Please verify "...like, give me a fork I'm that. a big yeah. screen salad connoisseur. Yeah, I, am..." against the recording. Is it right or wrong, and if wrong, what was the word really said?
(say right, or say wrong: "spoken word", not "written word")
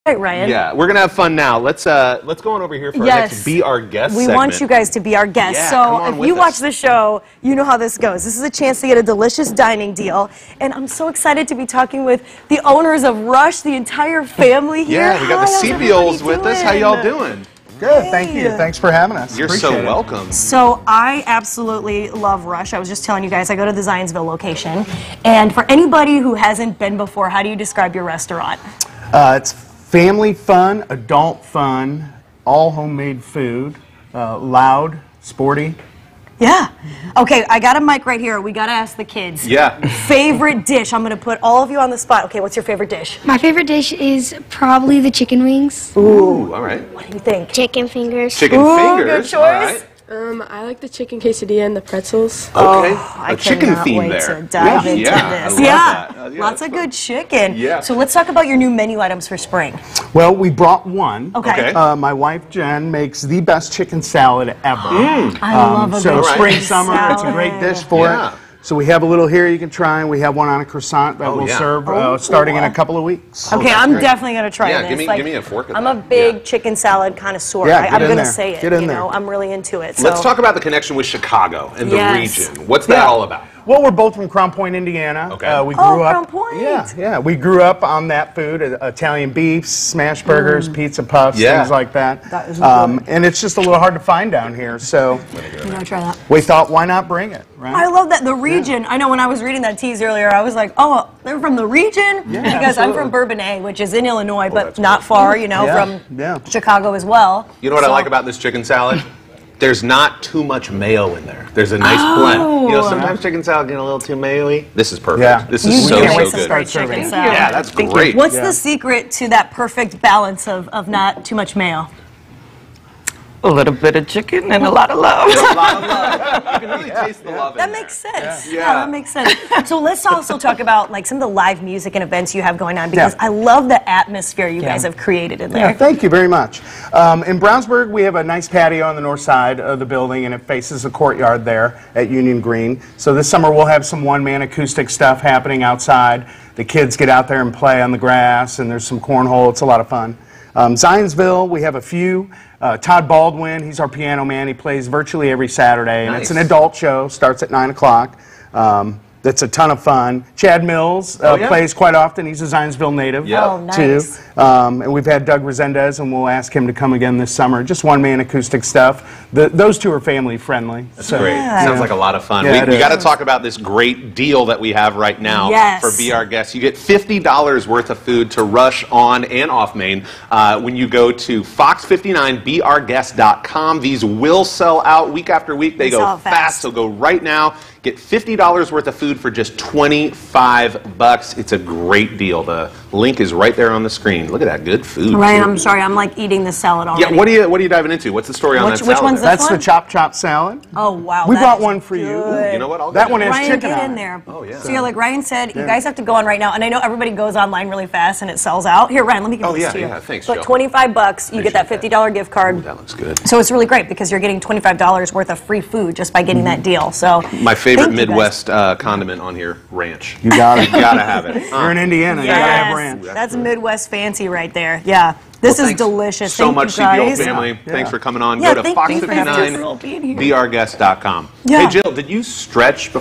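wrong: "chicken", not "screen".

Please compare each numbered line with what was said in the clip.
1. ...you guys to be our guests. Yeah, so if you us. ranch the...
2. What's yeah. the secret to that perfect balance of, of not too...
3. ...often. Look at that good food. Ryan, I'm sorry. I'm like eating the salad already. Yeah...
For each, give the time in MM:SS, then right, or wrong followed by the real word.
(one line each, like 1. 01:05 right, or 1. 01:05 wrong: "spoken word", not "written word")
1. 00:04 wrong: "watch", not "ranch"
2. 01:58 right
3. 03:13 wrong: "screen", not "often".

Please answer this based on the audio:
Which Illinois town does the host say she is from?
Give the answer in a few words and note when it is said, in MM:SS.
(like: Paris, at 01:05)
Bourbonnais, at 01:43.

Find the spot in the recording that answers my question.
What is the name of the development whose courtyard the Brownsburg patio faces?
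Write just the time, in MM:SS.
02:22.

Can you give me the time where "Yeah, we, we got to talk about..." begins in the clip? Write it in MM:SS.
02:52.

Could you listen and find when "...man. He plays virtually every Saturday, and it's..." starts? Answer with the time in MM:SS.
02:34.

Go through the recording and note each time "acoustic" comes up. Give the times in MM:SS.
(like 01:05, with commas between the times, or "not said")
02:24, 02:48.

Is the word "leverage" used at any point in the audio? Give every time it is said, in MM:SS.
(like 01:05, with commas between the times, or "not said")
not said.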